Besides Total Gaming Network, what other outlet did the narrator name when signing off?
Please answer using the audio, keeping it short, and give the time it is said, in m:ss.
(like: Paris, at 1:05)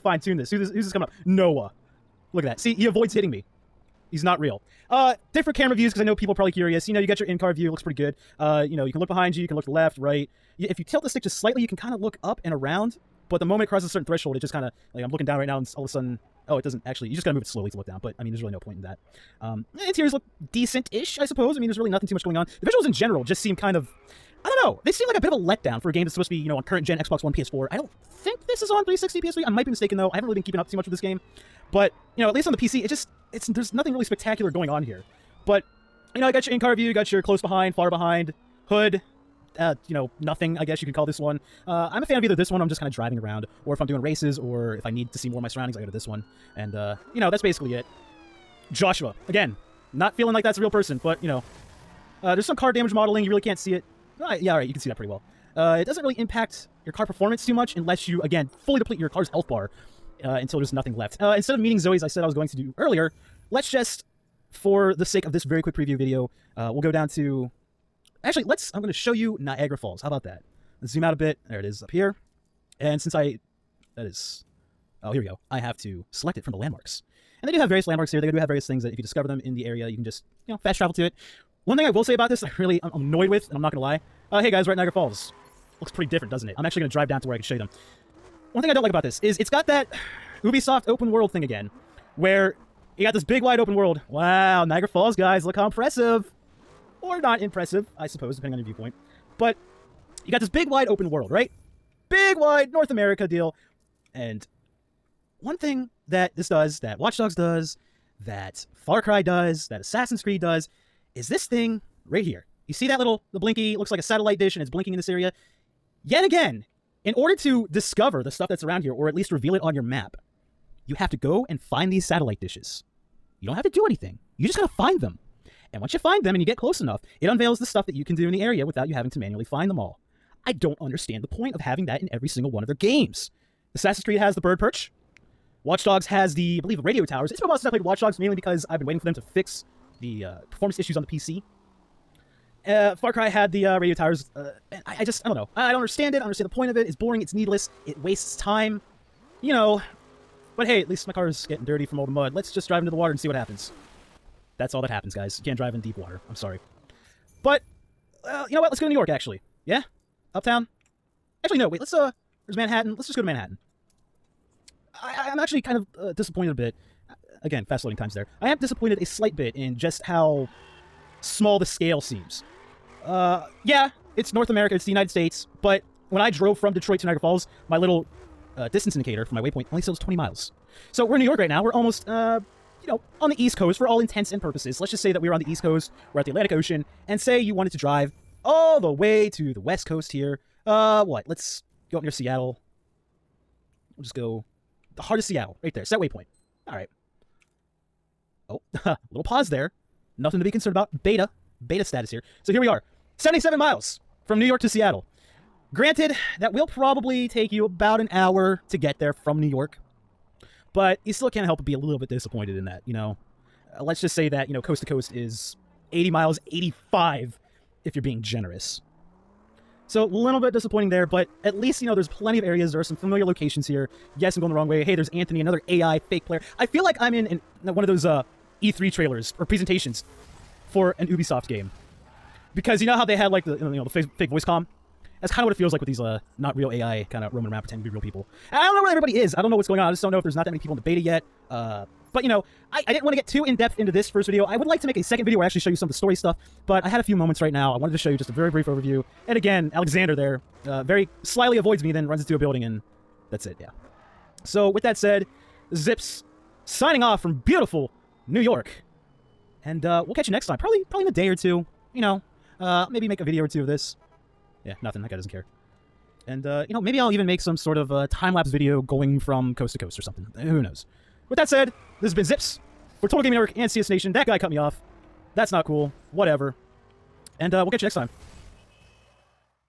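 CS Nation, at 4:33.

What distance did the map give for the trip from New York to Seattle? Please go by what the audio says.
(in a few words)
77 miles.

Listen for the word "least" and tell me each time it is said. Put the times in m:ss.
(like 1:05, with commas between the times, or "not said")
0:32, 1:59, 2:30, 3:41.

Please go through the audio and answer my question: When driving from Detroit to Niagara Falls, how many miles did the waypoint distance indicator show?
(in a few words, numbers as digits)
20 miles.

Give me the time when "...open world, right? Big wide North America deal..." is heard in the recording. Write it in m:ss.
1:40.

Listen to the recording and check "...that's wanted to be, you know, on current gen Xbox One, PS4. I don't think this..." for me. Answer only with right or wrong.
wrong.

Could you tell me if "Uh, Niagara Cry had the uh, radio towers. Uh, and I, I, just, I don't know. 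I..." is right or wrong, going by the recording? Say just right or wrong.
wrong.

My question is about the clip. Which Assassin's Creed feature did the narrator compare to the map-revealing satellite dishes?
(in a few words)
bird perch.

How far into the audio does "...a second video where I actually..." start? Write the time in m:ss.
4:04.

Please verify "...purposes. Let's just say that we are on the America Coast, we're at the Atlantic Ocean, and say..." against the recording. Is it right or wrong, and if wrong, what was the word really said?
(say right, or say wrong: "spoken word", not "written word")
wrong: "East", not "America".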